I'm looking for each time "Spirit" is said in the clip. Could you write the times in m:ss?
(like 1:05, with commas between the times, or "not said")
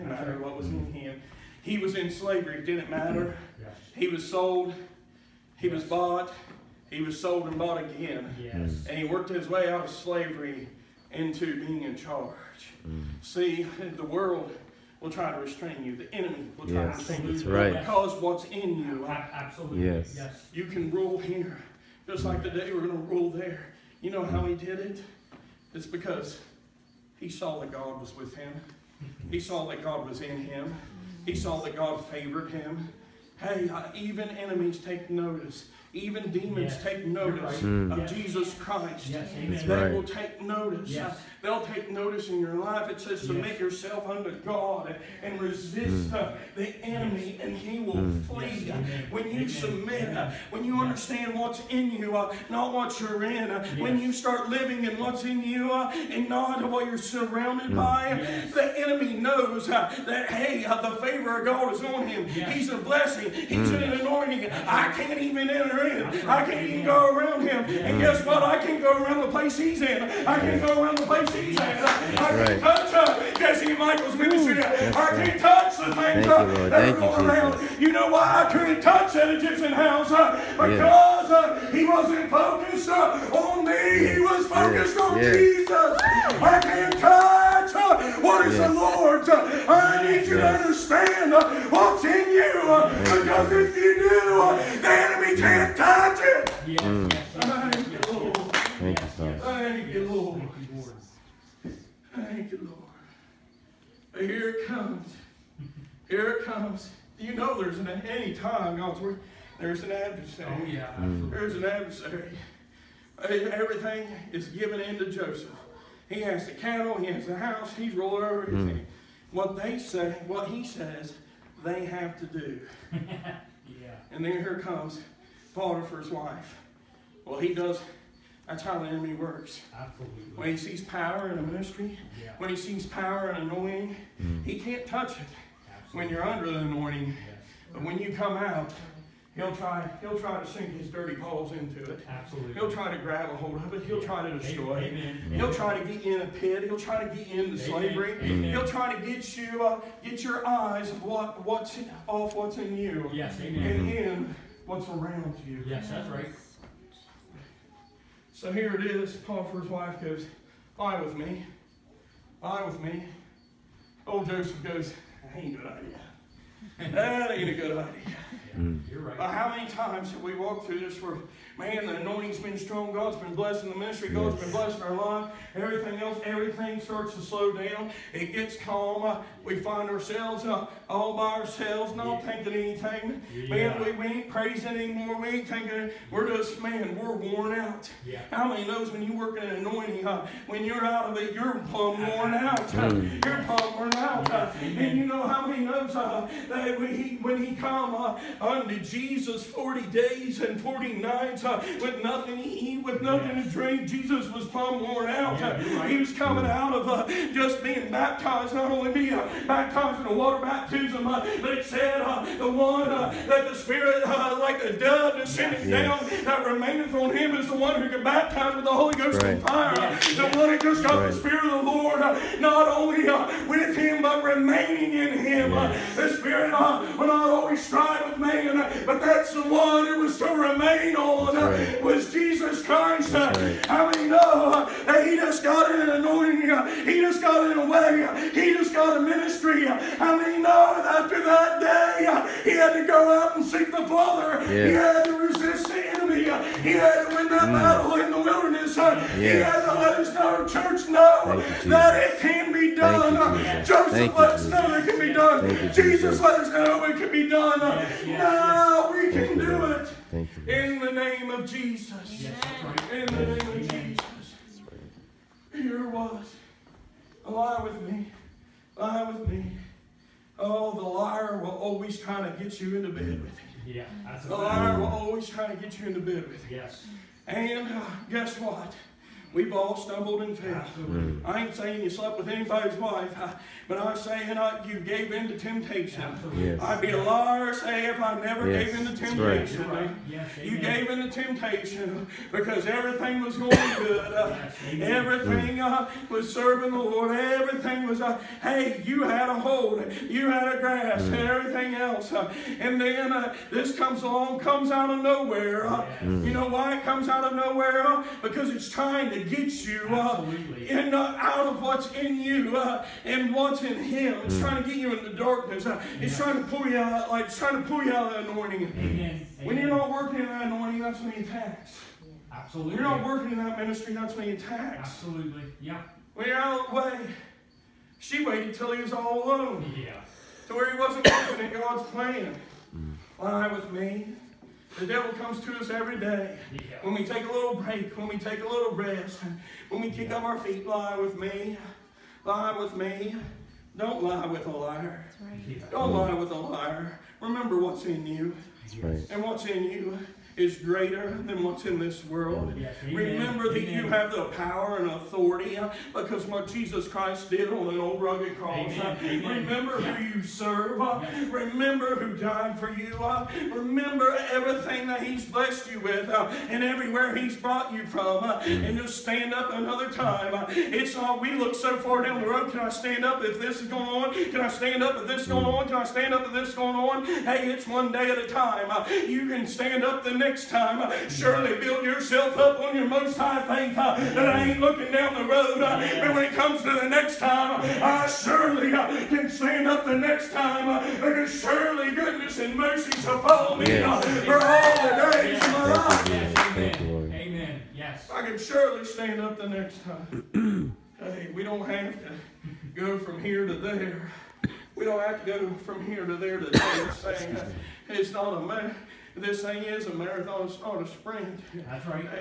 3:33, 3:41, 3:46.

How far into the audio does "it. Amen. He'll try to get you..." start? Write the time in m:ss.
2:24.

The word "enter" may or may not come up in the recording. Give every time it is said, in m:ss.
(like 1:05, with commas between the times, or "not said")
1:05.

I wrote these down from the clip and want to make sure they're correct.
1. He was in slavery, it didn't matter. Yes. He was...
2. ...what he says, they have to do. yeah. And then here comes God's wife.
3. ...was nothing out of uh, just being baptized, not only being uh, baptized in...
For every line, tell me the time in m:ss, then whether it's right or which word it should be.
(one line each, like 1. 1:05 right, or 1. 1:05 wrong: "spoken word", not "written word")
1. 0:01 right
2. 2:00 wrong: "Potiphar", not "God"
3. 3:25 wrong: "coming", not "nothing".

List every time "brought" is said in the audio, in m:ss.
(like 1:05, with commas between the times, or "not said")
6:07.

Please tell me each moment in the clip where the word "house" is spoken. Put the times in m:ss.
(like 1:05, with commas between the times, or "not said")
1:19, 1:57.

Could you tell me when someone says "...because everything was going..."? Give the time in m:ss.
4:52.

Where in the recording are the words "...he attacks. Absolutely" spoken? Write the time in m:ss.
5:24.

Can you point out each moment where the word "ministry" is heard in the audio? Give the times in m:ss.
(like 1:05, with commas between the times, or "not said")
1:14, 2:11, 2:53, 3:59, 5:23.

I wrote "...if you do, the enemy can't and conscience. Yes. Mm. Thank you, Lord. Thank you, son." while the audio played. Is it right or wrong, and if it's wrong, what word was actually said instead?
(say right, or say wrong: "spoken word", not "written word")
right.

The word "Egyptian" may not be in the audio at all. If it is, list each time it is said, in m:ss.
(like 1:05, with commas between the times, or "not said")
1:19.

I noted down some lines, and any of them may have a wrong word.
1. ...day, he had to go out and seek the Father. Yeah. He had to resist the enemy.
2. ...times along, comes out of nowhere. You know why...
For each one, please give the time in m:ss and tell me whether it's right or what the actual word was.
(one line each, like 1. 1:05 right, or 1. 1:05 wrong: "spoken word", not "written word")
1. 4:01 right
2. 5:03 wrong: "comes", not "times".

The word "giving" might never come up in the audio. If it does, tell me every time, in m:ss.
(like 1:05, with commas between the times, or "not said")
not said.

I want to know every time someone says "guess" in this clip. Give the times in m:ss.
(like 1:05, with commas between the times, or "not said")
1:08, 4:38.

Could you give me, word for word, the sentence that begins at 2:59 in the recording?
Uh, we find ourselves uh, all by ourselves, not yeah.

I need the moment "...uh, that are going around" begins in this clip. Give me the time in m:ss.
1:16.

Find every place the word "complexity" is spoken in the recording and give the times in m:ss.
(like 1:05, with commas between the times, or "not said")
not said.